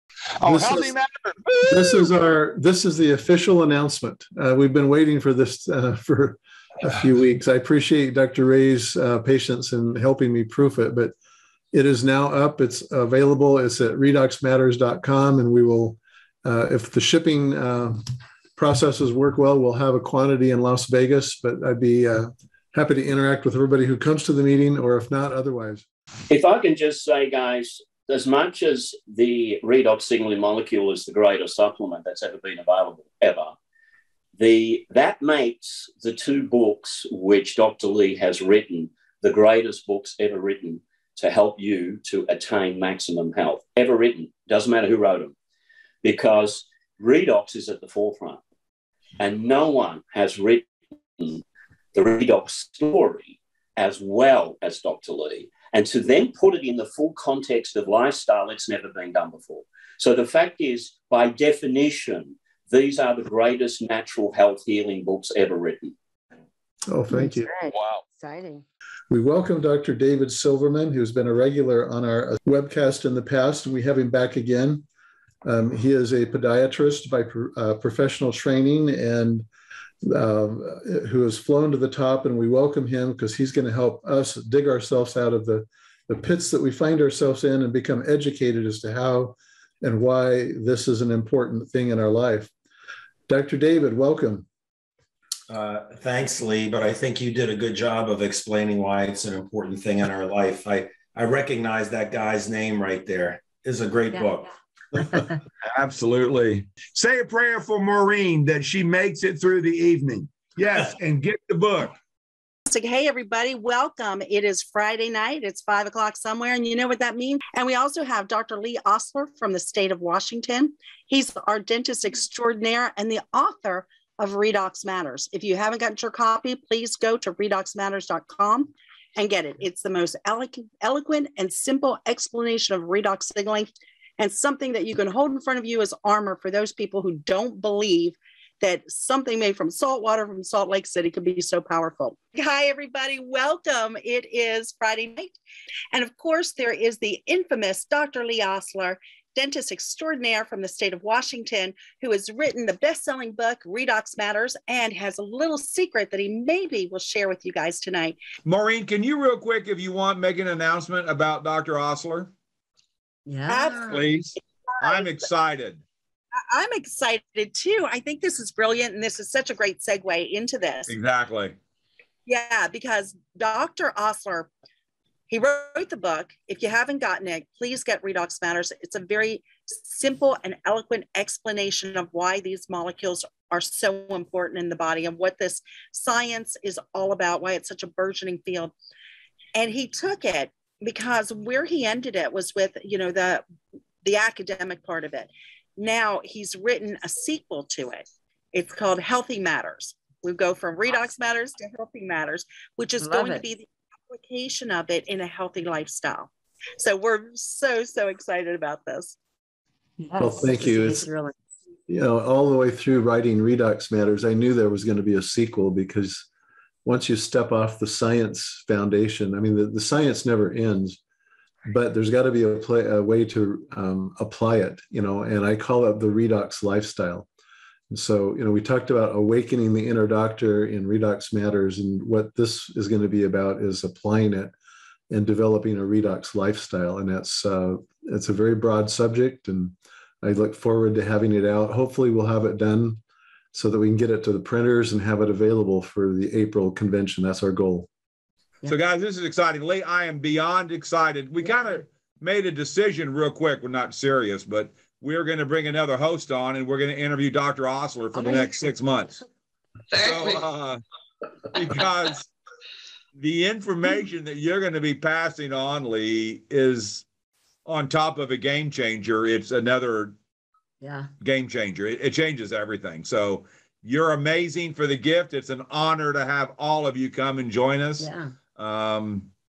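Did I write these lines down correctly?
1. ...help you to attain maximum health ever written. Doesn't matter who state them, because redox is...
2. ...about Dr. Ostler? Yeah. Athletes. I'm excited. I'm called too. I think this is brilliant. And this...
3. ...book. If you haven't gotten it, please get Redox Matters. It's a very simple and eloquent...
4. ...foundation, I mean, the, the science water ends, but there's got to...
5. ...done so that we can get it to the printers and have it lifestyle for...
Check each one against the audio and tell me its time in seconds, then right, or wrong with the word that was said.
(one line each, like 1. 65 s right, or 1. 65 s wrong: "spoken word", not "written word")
1. 41 s wrong: "wrote", not "state"
2. 161 s wrong: "excited", not "called"
3. 175 s right
4. 218 s wrong: "never", not "water"
5. 242 s wrong: "available", not "lifestyle".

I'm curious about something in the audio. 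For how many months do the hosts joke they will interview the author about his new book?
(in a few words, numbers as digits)
6.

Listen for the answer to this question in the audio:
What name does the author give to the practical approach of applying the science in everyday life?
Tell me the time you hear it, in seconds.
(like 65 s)
225 s.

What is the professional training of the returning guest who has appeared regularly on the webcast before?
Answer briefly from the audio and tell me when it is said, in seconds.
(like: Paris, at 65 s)
Podiatrist, at 76 s.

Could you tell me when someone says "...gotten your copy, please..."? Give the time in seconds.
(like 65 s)
125 s.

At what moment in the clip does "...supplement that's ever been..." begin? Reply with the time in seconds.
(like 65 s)
31 s.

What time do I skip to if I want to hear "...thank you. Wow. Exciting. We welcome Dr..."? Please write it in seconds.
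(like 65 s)
67 s.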